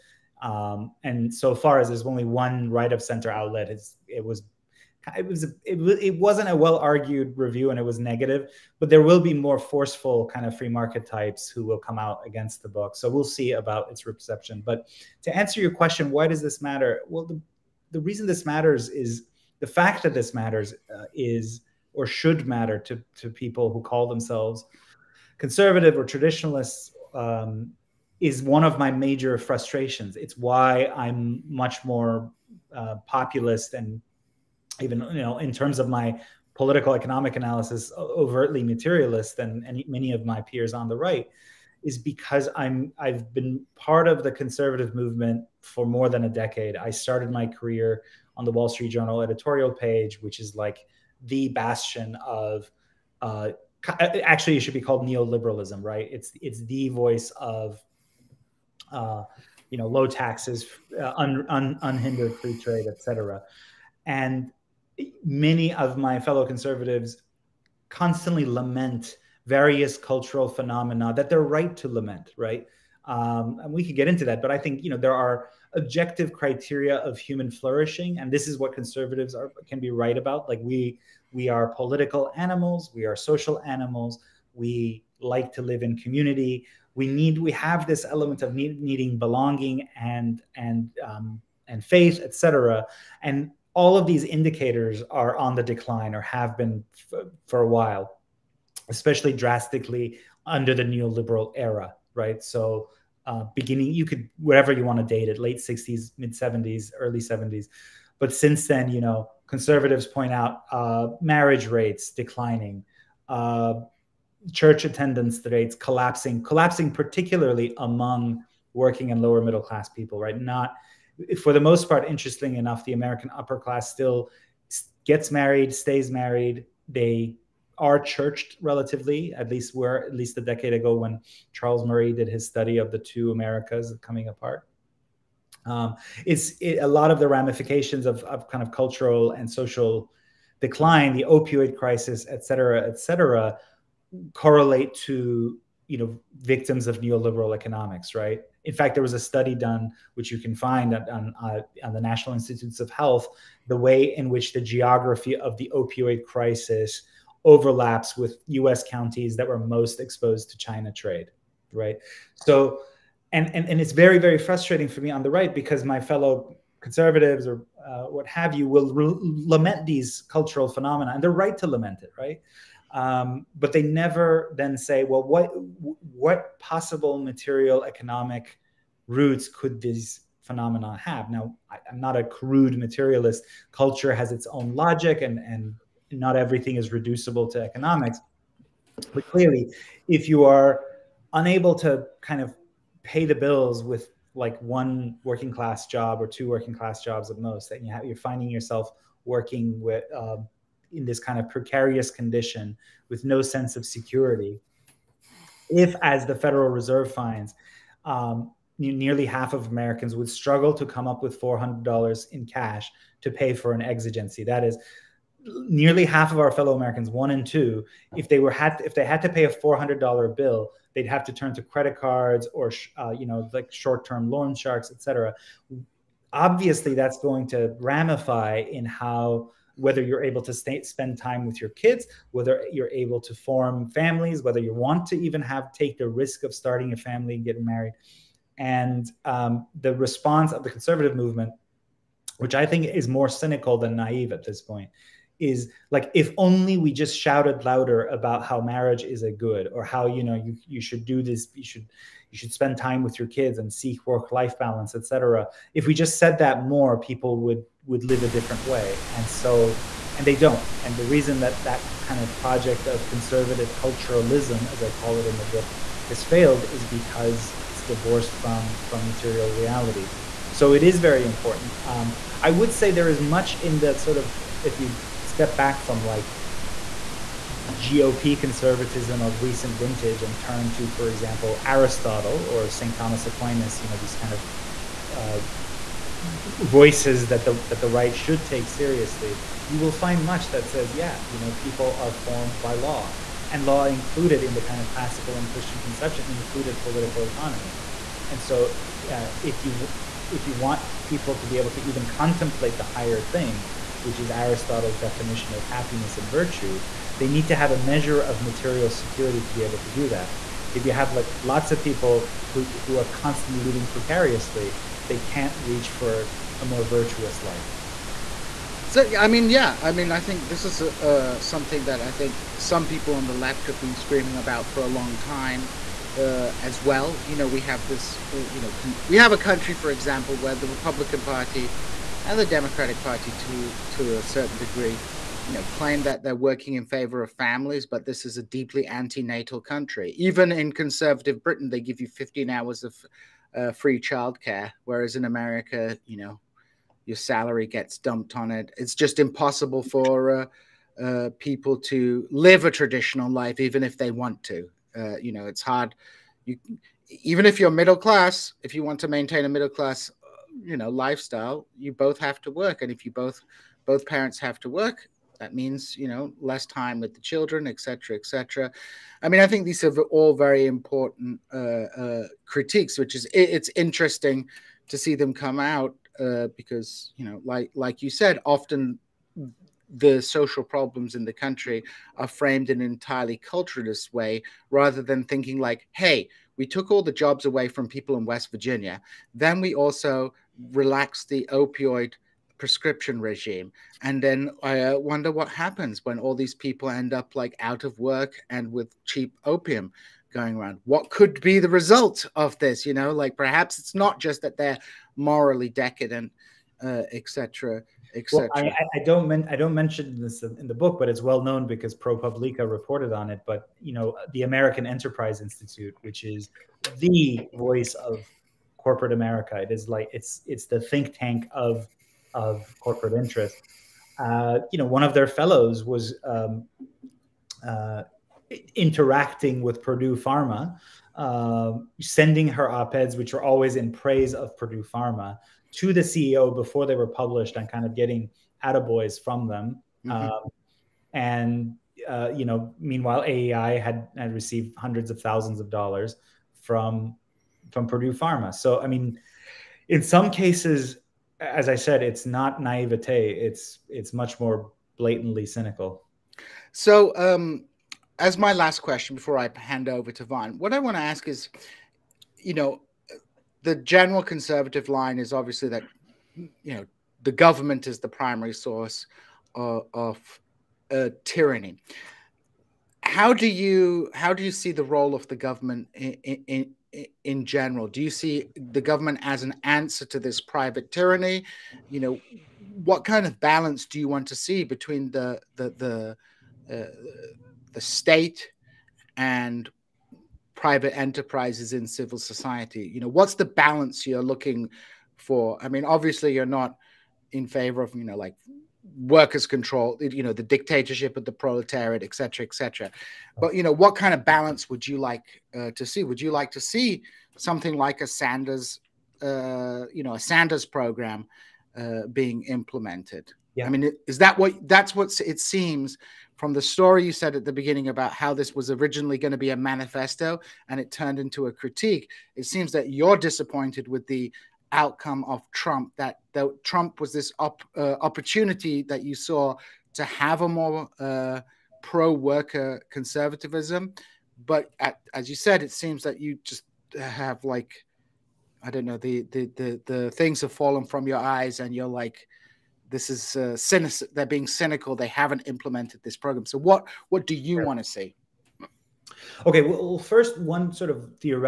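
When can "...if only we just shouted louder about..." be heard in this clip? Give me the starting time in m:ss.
4:06.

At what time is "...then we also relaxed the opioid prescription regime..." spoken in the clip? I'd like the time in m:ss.
6:29.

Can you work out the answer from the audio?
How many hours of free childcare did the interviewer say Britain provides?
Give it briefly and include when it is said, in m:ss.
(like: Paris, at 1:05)
15, at 5:42.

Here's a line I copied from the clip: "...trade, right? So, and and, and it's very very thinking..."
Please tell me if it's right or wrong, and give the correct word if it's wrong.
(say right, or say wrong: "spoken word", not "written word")
wrong: "frustrating", not "thinking".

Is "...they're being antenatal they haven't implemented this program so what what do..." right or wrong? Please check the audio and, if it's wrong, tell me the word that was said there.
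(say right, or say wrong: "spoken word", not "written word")
wrong: "cynical", not "antenatal".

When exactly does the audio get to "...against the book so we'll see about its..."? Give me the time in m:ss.
0:12.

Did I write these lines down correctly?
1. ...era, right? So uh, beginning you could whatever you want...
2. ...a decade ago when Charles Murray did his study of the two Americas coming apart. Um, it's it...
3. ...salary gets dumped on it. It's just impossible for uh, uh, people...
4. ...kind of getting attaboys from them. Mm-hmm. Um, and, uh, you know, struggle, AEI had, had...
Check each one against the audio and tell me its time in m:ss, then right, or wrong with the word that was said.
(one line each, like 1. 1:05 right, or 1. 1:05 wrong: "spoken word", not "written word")
1. 1:41 right
2. 2:10 right
3. 5:47 right
4. 7:17 wrong: "meanwhile", not "struggle".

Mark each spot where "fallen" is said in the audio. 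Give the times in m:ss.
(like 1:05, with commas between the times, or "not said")
9:00.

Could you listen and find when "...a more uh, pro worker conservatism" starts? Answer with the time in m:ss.
8:50.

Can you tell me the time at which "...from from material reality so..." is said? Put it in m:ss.
4:28.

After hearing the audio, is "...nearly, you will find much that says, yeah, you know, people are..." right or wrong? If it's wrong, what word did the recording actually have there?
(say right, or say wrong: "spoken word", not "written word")
wrong: "seriously", not "nearly".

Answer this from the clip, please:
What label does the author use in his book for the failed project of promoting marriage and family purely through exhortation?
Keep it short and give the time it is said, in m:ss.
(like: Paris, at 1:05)
conservative culturalism, at 4:23.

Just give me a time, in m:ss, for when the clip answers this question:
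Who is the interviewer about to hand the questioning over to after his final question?
7:40.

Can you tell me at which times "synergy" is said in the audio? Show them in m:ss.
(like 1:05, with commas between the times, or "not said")
not said.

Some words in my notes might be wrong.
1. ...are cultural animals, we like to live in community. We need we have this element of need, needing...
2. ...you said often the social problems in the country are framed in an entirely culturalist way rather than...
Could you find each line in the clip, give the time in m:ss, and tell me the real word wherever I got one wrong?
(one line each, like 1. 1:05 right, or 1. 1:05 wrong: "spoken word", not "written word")
1. 1:23 wrong: "social", not "cultural"
2. 6:18 right.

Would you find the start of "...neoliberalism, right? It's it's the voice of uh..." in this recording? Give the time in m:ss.
0:55.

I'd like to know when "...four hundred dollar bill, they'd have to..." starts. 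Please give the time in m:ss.
3:39.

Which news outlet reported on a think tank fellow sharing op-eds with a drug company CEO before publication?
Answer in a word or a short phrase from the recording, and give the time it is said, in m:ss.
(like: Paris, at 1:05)
ProPublica, at 6:51.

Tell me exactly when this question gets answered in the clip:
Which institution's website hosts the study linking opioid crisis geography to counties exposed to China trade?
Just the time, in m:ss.
2:31.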